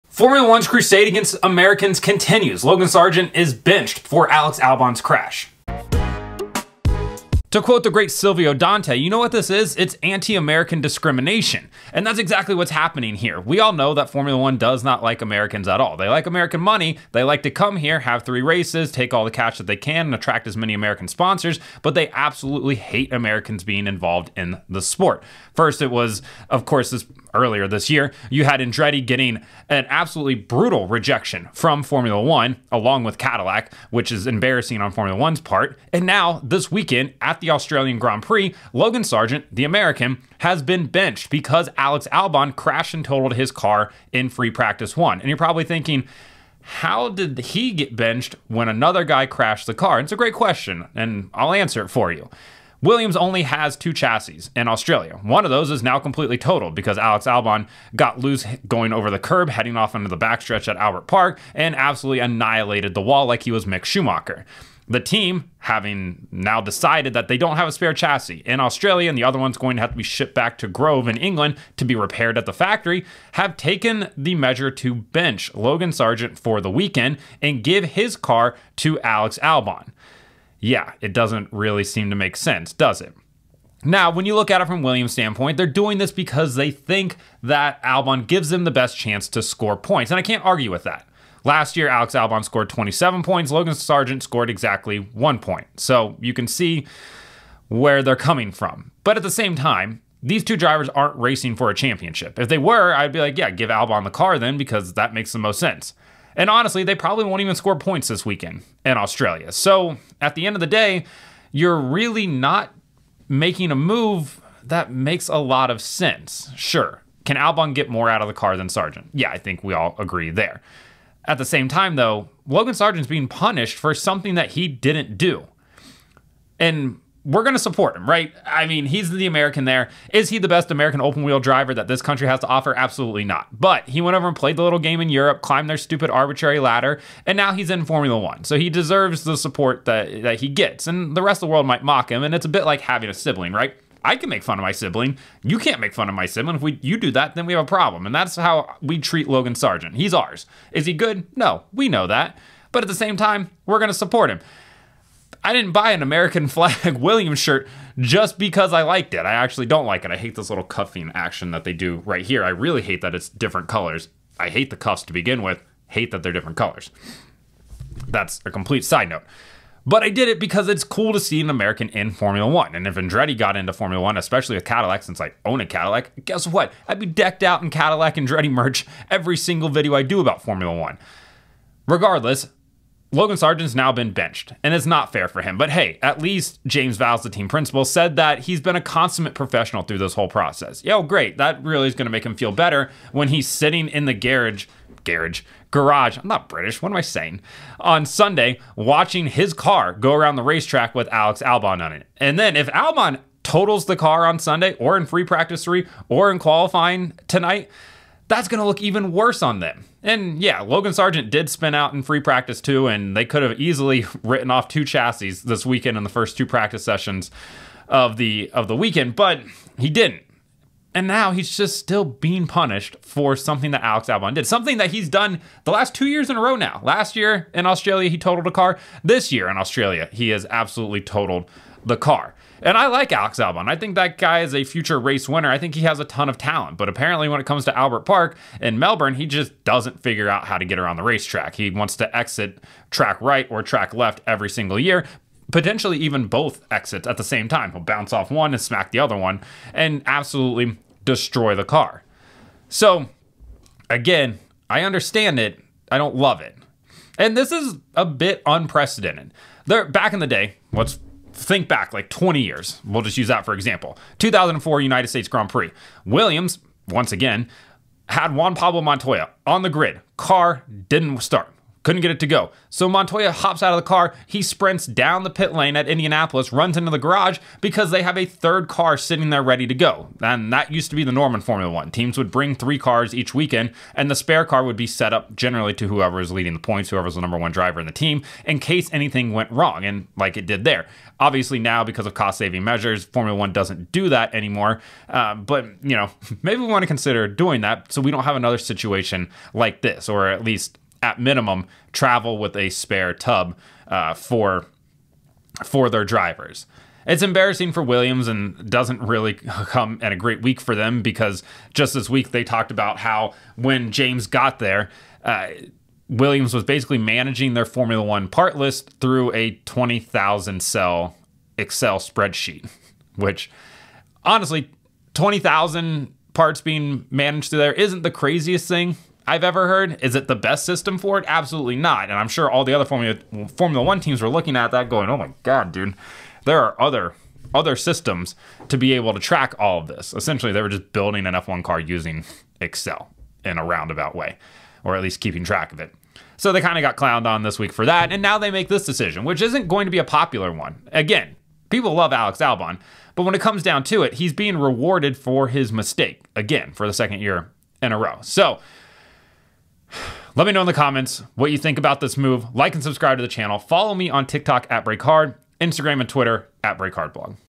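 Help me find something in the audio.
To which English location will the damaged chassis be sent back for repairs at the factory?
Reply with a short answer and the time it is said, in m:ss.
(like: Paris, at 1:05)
Grove, at 1:10.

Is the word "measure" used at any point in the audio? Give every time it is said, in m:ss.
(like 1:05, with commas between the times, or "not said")
1:14, 4:52.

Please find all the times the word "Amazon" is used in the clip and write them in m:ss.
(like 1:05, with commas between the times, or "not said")
not said.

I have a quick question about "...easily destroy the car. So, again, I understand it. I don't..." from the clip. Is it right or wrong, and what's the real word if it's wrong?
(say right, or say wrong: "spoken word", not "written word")
wrong: "absolutely", not "easily".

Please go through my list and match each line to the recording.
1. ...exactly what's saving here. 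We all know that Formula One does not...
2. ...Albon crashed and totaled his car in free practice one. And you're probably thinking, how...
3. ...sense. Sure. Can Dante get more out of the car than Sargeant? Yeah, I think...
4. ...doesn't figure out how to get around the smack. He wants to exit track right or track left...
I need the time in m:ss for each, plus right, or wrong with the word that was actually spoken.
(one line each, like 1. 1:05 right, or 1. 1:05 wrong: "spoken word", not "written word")
1. 0:12 wrong: "happening", not "saving"
2. 0:42 right
3. 1:55 wrong: "Albon", not "Dante"
4. 3:59 wrong: "racetrack", not "smack".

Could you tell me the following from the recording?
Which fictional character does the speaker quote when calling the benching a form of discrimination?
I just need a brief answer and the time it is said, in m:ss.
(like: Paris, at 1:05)
Silvio Dante, at 0:08.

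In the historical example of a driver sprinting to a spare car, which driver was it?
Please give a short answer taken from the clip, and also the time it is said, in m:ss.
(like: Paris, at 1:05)
Juan Pablo Montoya, at 4:28.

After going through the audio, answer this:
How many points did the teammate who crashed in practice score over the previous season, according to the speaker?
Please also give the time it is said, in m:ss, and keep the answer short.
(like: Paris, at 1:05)
27, at 1:32.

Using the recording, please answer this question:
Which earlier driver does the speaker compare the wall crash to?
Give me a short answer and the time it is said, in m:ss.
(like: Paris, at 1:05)
Mick Schumacher, at 1:03.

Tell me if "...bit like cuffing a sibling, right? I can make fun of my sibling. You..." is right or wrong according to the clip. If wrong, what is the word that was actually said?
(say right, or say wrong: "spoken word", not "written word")
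wrong: "having", not "cuffing".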